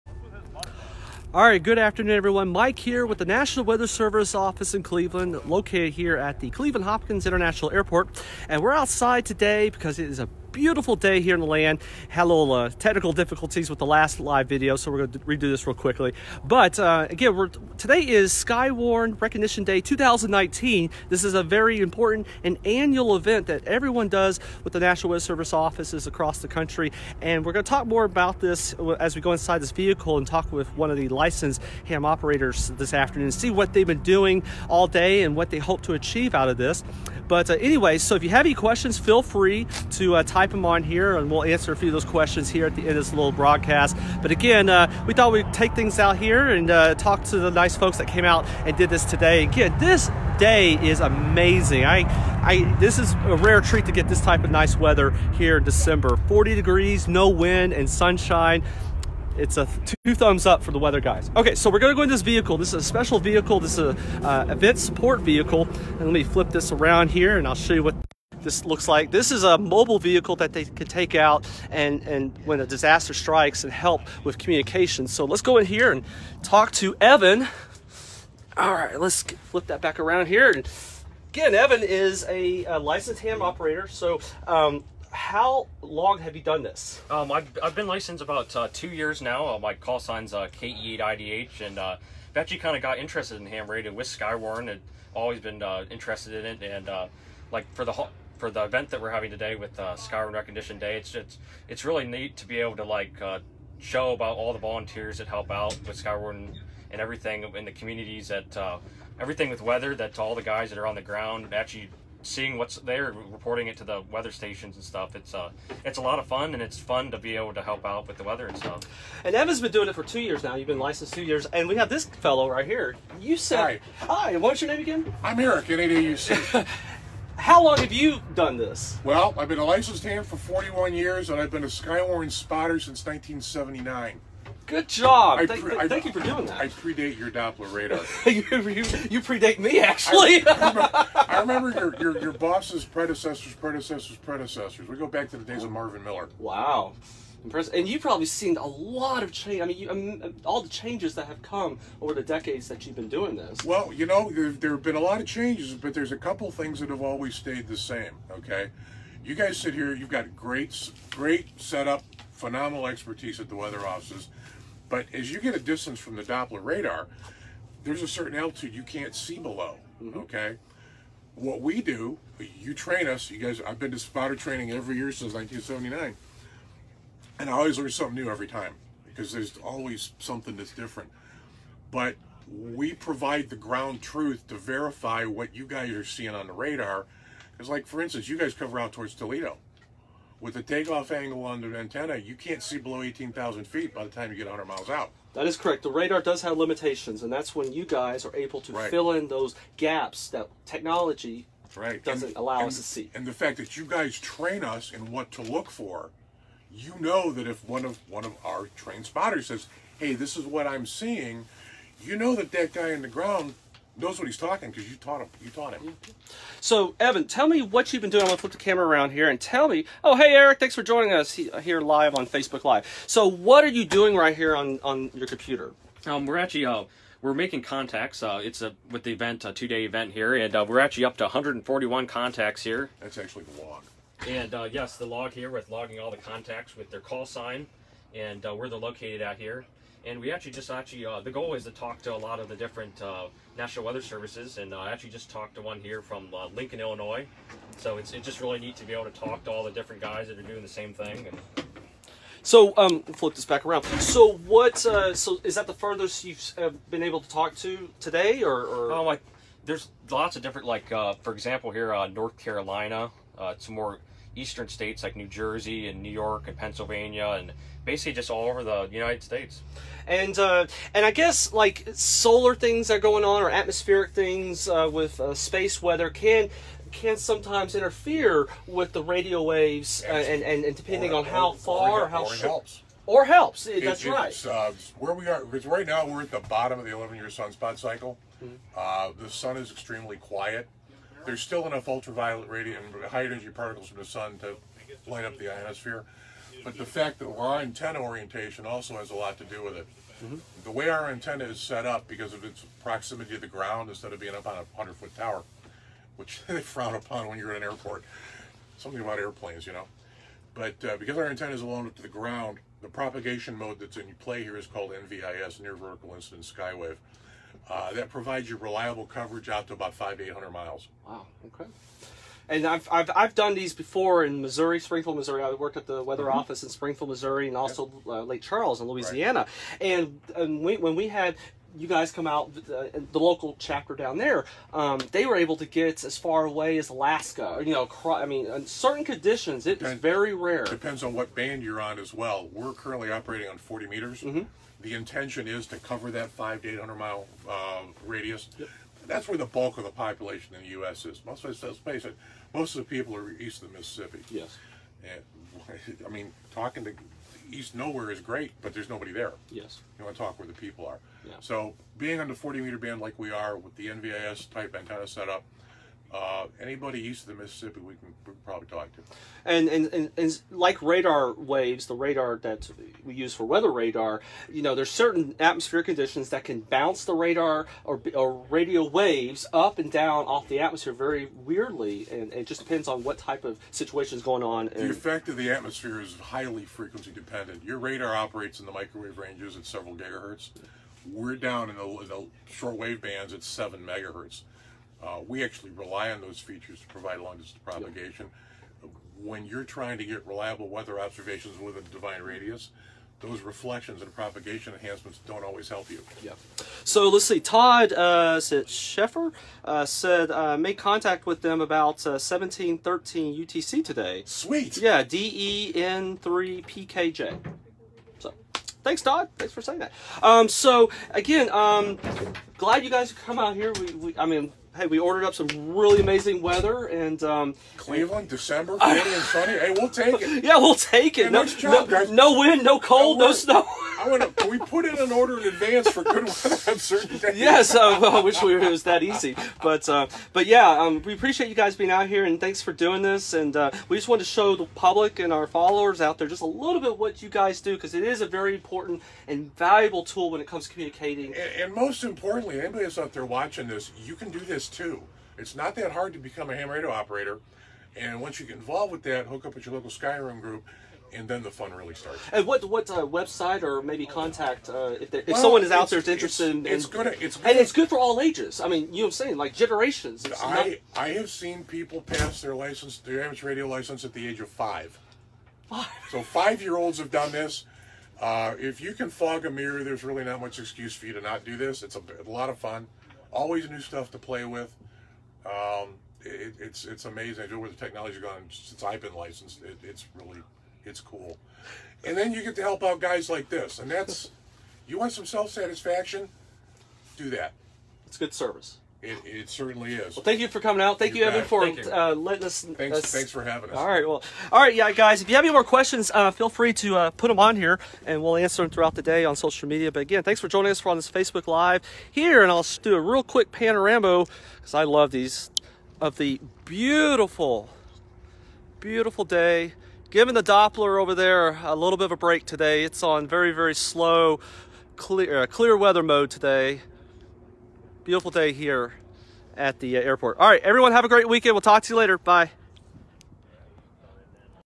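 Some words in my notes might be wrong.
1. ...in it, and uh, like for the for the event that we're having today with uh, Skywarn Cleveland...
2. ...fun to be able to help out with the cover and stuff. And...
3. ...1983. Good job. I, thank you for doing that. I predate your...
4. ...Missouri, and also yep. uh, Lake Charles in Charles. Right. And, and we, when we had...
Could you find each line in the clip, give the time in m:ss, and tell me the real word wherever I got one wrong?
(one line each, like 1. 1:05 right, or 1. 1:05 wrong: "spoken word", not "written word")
1. 1:36 wrong: "Recognition", not "Cleveland"
2. 1:56 wrong: "weather", not "cover"
3. 2:13 wrong: "1979", not "1983"
4. 5:27 wrong: "Louisiana", not "Charles".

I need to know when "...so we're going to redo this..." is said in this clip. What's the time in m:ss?
0:14.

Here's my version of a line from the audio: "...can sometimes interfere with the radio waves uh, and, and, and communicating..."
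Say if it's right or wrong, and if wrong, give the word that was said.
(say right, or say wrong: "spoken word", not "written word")
wrong: "depending", not "communicating".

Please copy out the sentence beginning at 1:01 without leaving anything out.
Okay, so we're gonna go in this vehicle.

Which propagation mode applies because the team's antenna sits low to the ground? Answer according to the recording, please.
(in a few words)
Near Vertical Incident Skywave.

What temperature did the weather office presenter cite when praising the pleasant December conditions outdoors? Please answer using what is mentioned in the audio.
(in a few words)
40 degrees.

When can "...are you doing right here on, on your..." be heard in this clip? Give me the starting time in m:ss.
3:43.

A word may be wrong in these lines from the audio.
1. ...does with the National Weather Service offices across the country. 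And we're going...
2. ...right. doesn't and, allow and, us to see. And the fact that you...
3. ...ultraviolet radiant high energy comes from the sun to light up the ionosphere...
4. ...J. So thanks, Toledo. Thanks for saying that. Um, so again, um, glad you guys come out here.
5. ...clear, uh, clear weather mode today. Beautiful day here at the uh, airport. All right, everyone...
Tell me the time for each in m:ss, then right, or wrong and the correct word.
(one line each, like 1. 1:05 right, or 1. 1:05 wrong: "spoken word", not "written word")
1. 0:24 right
2. 3:21 right
3. 4:51 wrong: "particles", not "comes"
4. 6:57 wrong: "Todd", not "Toledo"
5. 8:44 right.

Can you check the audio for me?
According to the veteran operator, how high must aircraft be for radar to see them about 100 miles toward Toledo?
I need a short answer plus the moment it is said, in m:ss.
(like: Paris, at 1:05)
18,000 feet, at 3:13.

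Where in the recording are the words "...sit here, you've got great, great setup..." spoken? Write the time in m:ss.
2:39.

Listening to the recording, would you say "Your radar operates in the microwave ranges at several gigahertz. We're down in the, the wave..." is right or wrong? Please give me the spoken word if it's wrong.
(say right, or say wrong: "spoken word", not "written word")
right.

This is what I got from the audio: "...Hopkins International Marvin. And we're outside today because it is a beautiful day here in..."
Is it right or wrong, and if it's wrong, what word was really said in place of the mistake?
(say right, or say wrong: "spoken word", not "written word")
wrong: "Airport", not "Marvin".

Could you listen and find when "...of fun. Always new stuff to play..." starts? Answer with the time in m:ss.
8:02.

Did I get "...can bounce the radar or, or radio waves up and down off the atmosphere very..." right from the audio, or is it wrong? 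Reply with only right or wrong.
right.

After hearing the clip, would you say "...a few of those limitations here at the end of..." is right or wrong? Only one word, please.
wrong.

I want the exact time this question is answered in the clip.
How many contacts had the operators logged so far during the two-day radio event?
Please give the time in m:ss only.
3:51.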